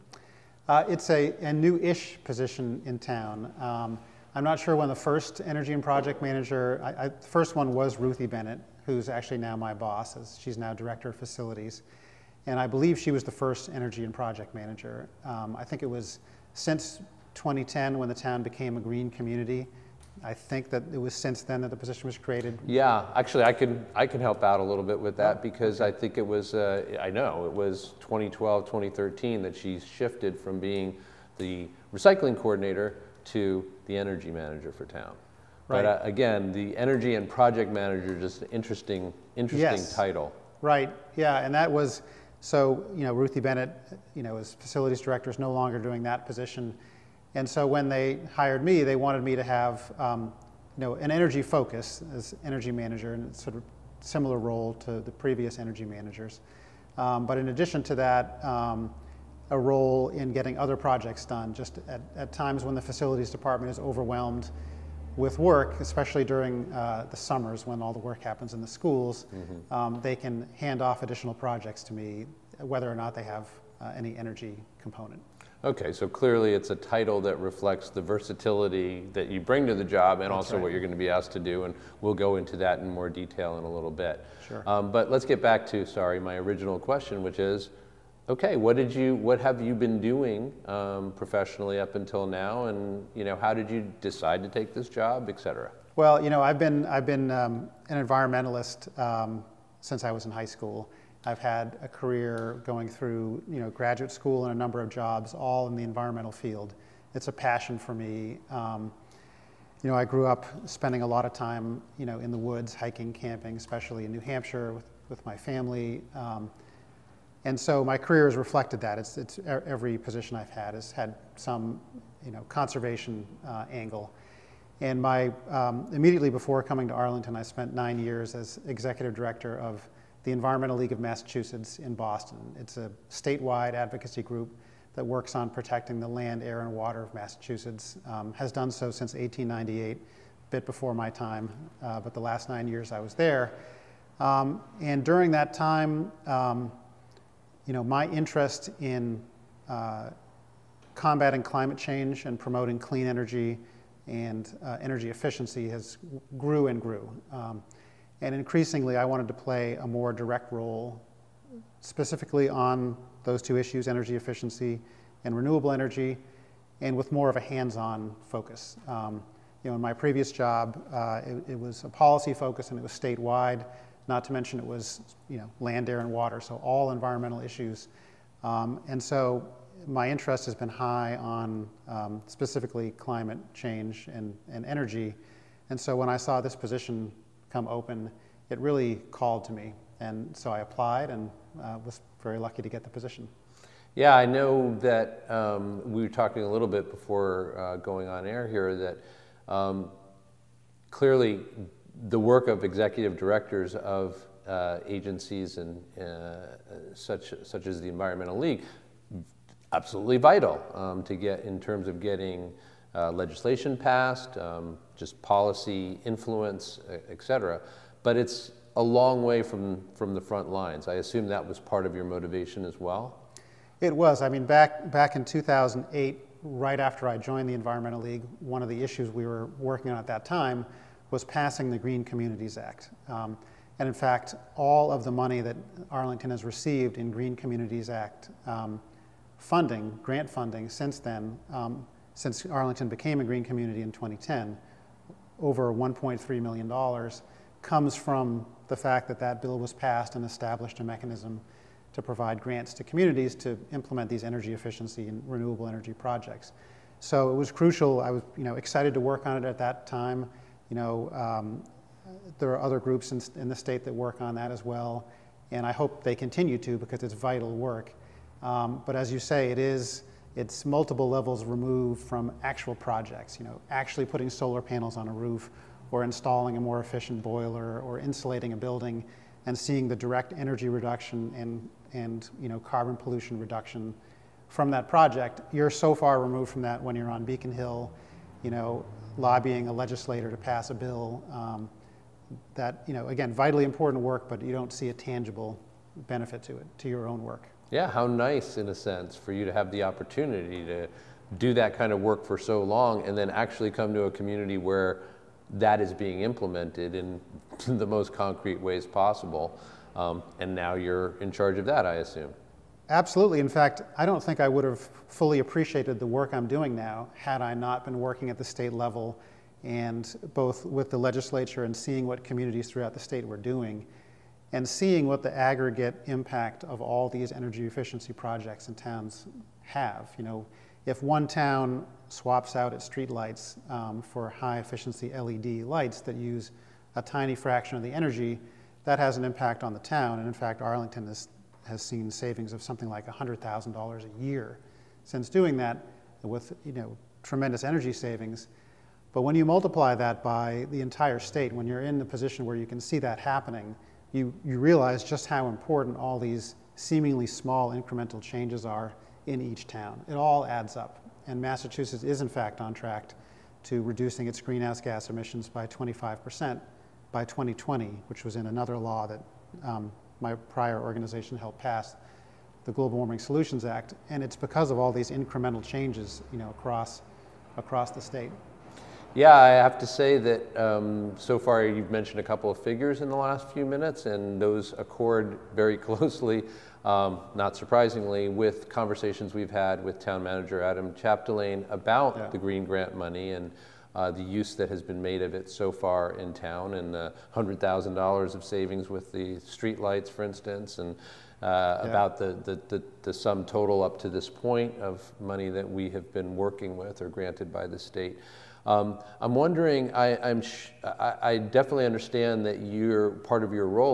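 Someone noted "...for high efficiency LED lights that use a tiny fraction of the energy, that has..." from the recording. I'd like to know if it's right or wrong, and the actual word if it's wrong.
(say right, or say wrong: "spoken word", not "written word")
right.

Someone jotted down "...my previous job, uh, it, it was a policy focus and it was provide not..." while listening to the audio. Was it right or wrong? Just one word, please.
wrong.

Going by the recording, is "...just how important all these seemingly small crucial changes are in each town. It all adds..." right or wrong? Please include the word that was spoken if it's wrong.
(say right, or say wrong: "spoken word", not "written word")
wrong: "incremental", not "crucial".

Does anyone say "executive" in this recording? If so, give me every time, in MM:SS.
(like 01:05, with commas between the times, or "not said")
02:08, 03:22.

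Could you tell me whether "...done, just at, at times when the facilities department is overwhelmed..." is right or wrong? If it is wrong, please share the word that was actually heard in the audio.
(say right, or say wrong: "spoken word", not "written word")
right.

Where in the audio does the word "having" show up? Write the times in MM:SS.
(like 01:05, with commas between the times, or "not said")
not said.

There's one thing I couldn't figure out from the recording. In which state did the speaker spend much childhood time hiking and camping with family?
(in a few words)
New Hampshire.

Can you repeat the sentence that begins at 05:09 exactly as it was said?
Um, and now you're in charge of that, I assume.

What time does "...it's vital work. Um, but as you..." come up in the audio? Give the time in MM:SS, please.
04:27.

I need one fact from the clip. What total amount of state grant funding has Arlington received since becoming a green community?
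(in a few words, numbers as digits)
Over $1.3 million.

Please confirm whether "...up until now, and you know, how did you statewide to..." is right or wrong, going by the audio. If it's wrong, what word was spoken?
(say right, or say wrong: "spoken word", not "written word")
wrong: "decide", not "statewide".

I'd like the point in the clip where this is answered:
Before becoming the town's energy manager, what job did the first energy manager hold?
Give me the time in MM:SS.
00:31.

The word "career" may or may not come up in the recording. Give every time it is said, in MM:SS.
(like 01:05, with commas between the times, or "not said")
01:41, 01:57.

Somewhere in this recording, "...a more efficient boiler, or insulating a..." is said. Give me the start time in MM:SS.
04:36.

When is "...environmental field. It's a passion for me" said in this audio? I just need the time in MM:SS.
01:45.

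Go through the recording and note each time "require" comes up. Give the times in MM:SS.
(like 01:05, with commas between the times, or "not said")
not said.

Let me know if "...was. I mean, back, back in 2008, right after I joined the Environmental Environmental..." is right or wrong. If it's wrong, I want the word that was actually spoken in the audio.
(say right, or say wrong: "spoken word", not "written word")
wrong: "League", not "Environmental".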